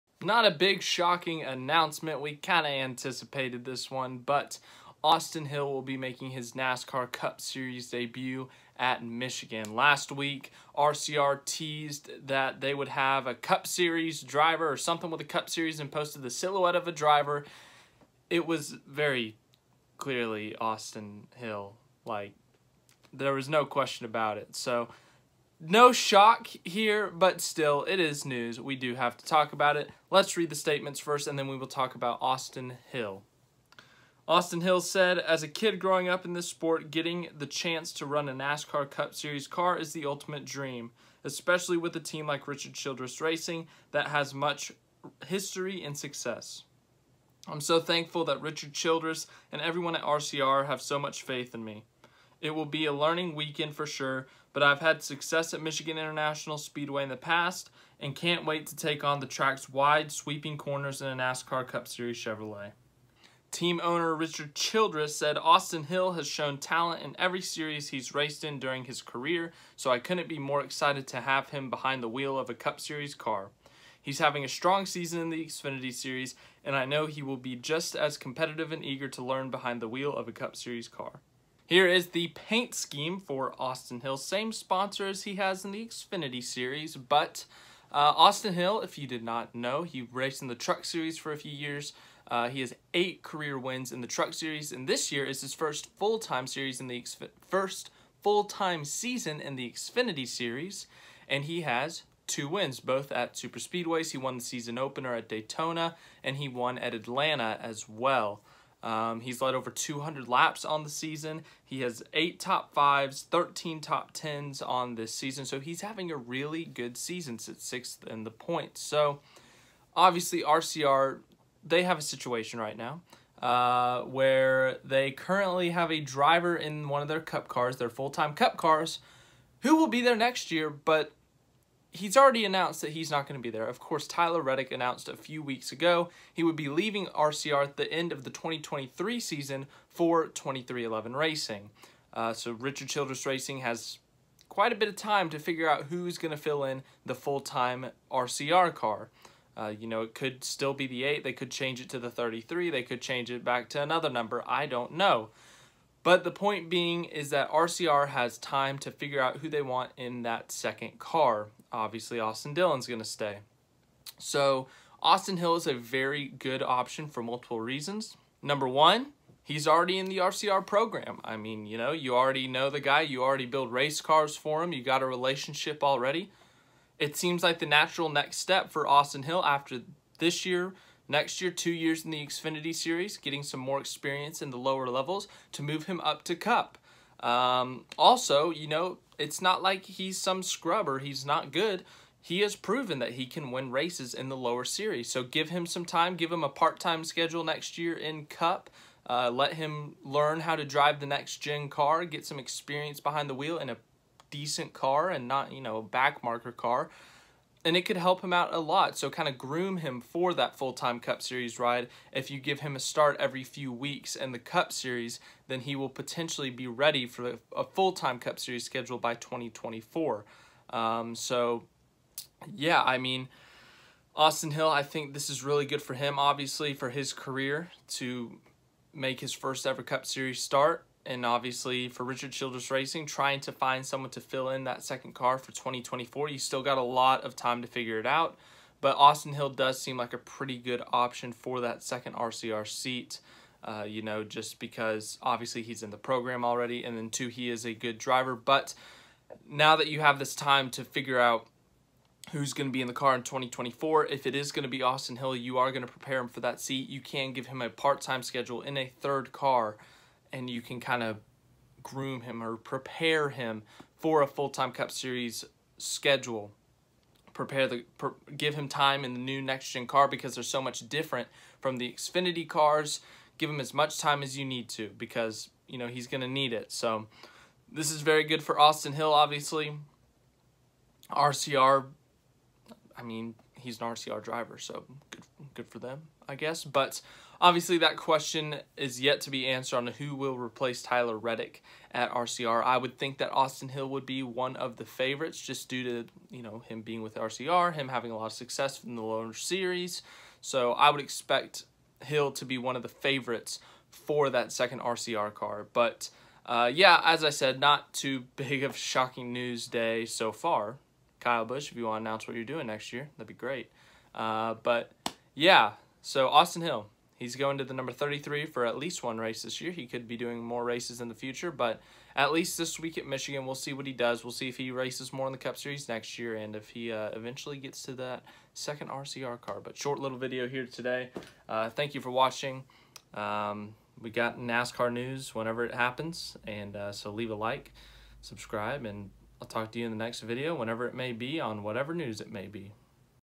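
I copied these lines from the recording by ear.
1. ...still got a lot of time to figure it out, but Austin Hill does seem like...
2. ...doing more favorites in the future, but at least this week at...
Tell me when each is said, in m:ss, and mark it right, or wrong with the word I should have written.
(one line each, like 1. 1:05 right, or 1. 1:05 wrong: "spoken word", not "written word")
1. 3:56 right
2. 5:20 wrong: "races", not "favorites".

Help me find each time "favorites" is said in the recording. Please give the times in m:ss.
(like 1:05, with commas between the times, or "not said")
4:54, 5:02.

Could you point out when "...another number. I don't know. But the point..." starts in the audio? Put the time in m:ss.
2:33.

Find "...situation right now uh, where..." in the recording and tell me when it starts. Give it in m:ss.
2:02.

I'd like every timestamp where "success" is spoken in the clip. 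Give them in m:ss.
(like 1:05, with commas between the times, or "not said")
0:45, 0:55, 4:58.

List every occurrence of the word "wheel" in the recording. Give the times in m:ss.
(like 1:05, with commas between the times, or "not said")
1:12, 1:19, 3:23.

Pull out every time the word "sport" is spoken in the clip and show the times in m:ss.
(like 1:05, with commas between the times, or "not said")
0:36.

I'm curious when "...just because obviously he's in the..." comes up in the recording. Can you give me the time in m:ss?
4:04.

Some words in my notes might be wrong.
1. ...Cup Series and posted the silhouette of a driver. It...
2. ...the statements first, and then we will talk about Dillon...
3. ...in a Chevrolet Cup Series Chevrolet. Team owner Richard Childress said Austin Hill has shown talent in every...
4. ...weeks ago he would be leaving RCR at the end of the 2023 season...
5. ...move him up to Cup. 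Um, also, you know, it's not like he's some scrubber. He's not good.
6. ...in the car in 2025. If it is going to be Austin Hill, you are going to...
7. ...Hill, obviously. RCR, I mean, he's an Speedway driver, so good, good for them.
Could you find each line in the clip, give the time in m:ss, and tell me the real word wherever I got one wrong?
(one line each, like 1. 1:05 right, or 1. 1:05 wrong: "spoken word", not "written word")
1. 0:15 right
2. 0:30 wrong: "Austin", not "Dillon"
3. 1:01 wrong: "NASCAR", not "Chevrolet"
4. 2:15 right
5. 3:05 right
6. 4:12 wrong: "2024", not "2025"
7. 4:38 wrong: "RCR", not "Speedway".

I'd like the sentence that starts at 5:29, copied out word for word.
But short little video here today.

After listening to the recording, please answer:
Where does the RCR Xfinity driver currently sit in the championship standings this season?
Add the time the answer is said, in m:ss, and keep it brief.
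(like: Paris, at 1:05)
Sixth, at 1:57.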